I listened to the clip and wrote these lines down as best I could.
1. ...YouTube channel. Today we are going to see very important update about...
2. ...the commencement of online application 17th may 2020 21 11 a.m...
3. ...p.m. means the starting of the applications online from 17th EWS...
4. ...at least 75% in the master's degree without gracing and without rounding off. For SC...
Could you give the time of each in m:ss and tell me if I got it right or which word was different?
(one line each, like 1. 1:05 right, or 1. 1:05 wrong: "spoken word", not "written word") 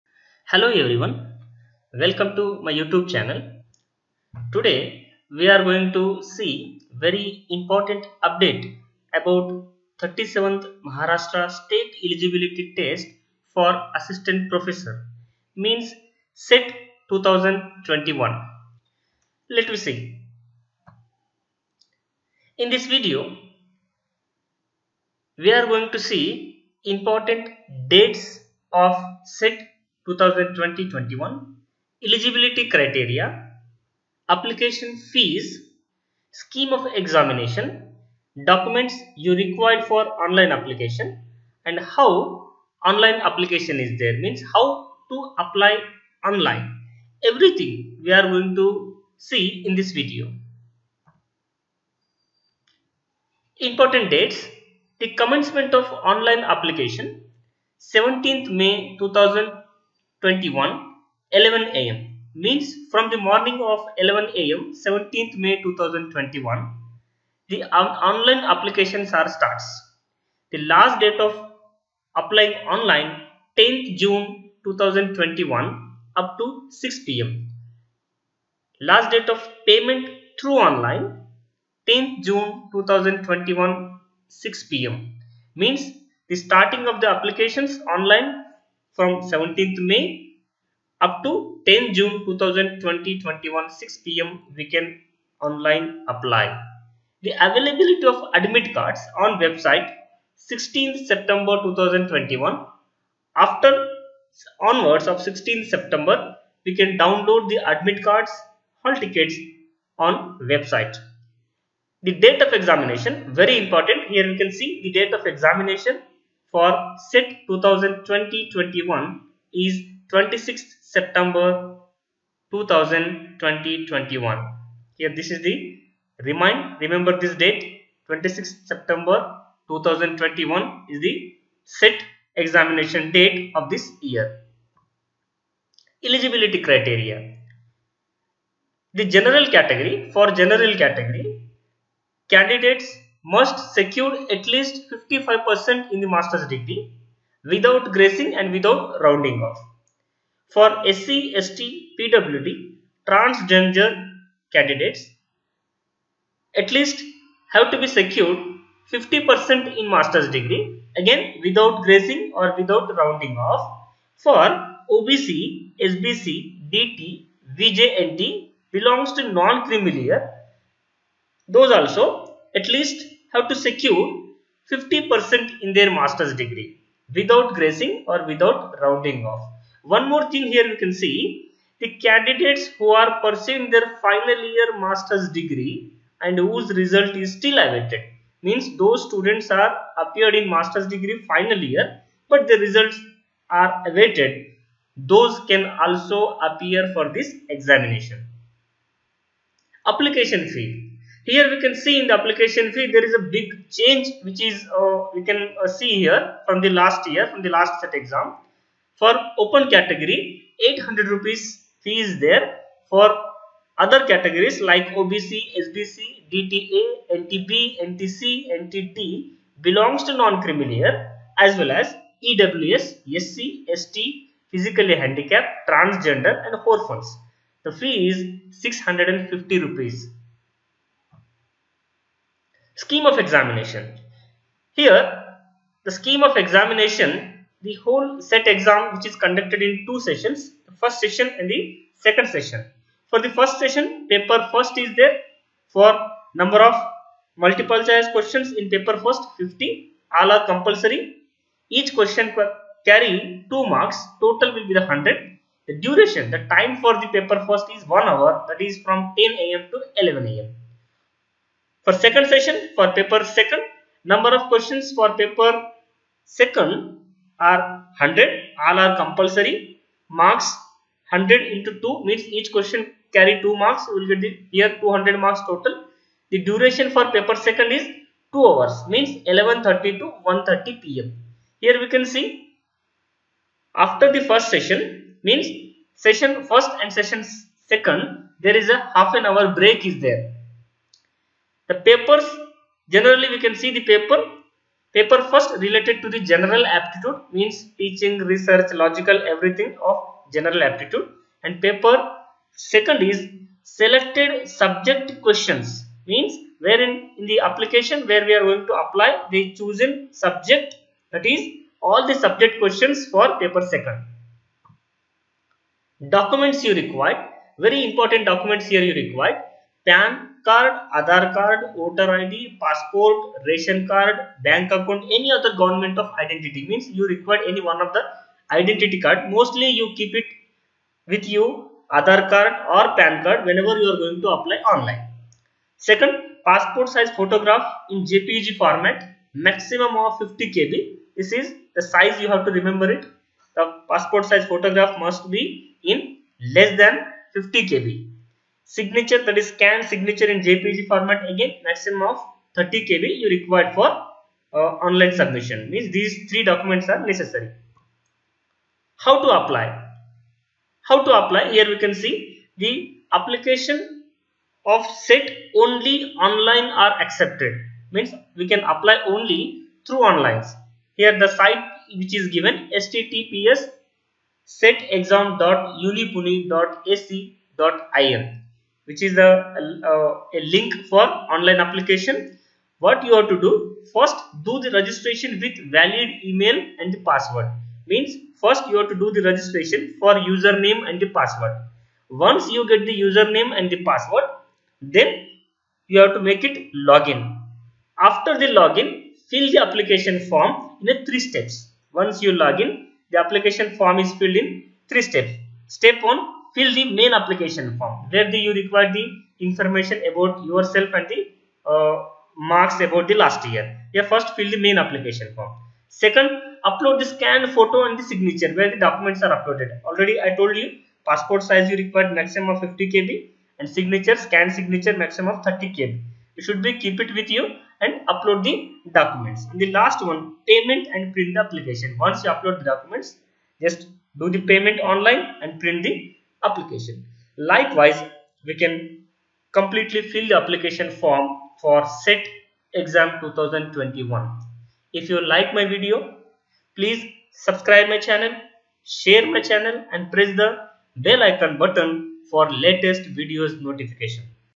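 1. 0:02 right
2. 0:55 right
3. 1:24 wrong: "May", not "EWS"
4. 2:24 wrong: "55", not "75".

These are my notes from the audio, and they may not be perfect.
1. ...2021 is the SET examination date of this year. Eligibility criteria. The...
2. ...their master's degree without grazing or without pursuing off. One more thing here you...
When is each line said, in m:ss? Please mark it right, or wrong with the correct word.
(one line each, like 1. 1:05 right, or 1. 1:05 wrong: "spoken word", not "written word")
1. 2:09 right
2. 2:55 wrong: "rounding", not "pursuing".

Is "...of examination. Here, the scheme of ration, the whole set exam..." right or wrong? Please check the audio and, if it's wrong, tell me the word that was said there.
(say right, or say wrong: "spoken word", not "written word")
wrong: "examination", not "ration".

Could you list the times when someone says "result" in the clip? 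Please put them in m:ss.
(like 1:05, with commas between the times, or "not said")
3:06, 3:12.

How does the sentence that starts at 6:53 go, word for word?
Yeah, first fill the main application form.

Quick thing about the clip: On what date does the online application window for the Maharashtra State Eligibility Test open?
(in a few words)
17 May 2021.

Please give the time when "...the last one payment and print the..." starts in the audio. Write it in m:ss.
7:09.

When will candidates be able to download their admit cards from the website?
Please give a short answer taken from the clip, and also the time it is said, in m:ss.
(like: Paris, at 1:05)
16 September 2021, at 1:40.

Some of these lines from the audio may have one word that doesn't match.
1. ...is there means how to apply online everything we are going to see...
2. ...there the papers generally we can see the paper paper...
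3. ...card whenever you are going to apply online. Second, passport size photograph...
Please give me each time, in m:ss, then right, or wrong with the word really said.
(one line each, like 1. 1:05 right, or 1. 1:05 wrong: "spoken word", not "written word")
1. 0:43 right
2. 4:50 right
3. 5:33 right.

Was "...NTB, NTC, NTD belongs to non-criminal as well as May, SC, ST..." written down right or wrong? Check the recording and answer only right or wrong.
wrong.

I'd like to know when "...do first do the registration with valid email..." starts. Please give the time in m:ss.
6:23.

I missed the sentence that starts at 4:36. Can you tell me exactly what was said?
The duration for paper second is 2 hours means 11.30 to 1.30 pm.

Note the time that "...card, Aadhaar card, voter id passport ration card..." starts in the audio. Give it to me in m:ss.
5:20.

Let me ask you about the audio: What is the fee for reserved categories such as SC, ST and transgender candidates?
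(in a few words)
650 rupees.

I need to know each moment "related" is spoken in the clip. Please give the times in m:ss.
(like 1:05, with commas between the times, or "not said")
4:55.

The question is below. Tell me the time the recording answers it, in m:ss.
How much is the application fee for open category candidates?
3:30.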